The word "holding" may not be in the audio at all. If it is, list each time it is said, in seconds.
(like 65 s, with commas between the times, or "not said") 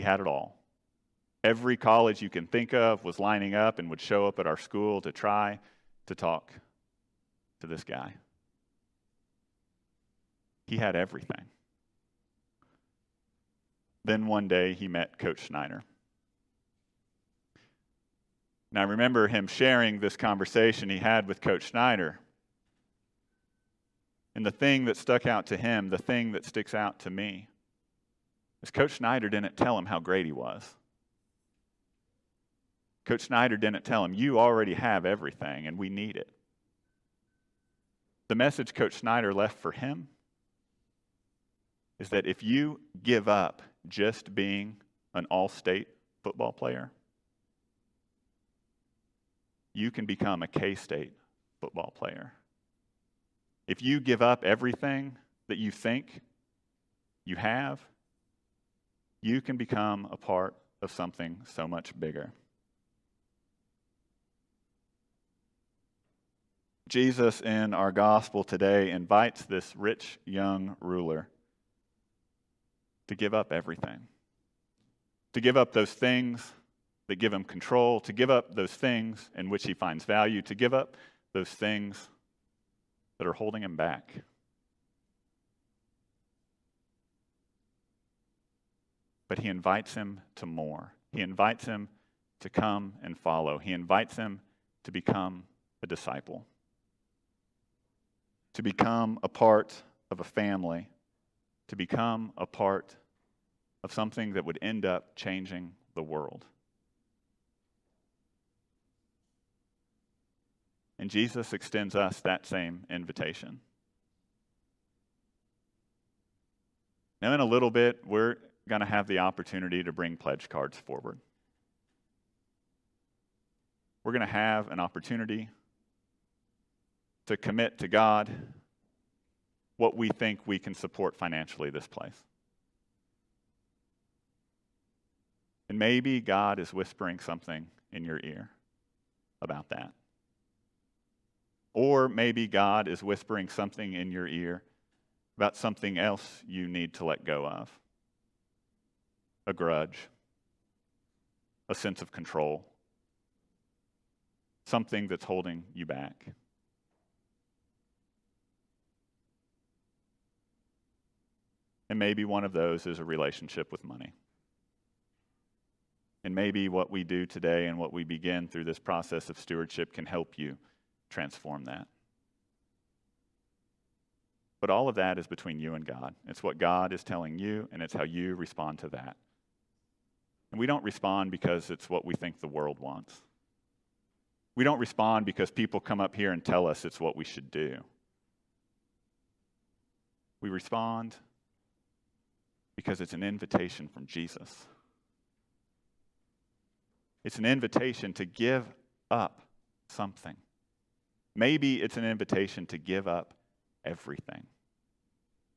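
83 s, 155 s.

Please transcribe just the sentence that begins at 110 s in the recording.
And Jesus extends us that same invitation.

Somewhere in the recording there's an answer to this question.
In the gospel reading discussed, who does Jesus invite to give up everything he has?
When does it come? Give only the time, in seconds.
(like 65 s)
69 s.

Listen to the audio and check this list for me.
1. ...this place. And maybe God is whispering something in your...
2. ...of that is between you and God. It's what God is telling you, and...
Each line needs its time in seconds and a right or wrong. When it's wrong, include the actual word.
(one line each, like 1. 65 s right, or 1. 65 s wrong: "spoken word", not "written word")
1. 131 s right
2. 174 s right.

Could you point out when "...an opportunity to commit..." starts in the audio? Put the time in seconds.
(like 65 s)
124 s.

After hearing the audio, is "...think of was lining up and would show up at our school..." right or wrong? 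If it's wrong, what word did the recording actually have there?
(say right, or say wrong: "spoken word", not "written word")
right.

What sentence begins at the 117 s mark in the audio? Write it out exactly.
Now, in a little bit, we're going to have the opportunity to bring pledge cards forward.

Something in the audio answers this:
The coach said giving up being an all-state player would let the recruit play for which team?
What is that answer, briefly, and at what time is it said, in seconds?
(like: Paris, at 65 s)
K State, at 50 s.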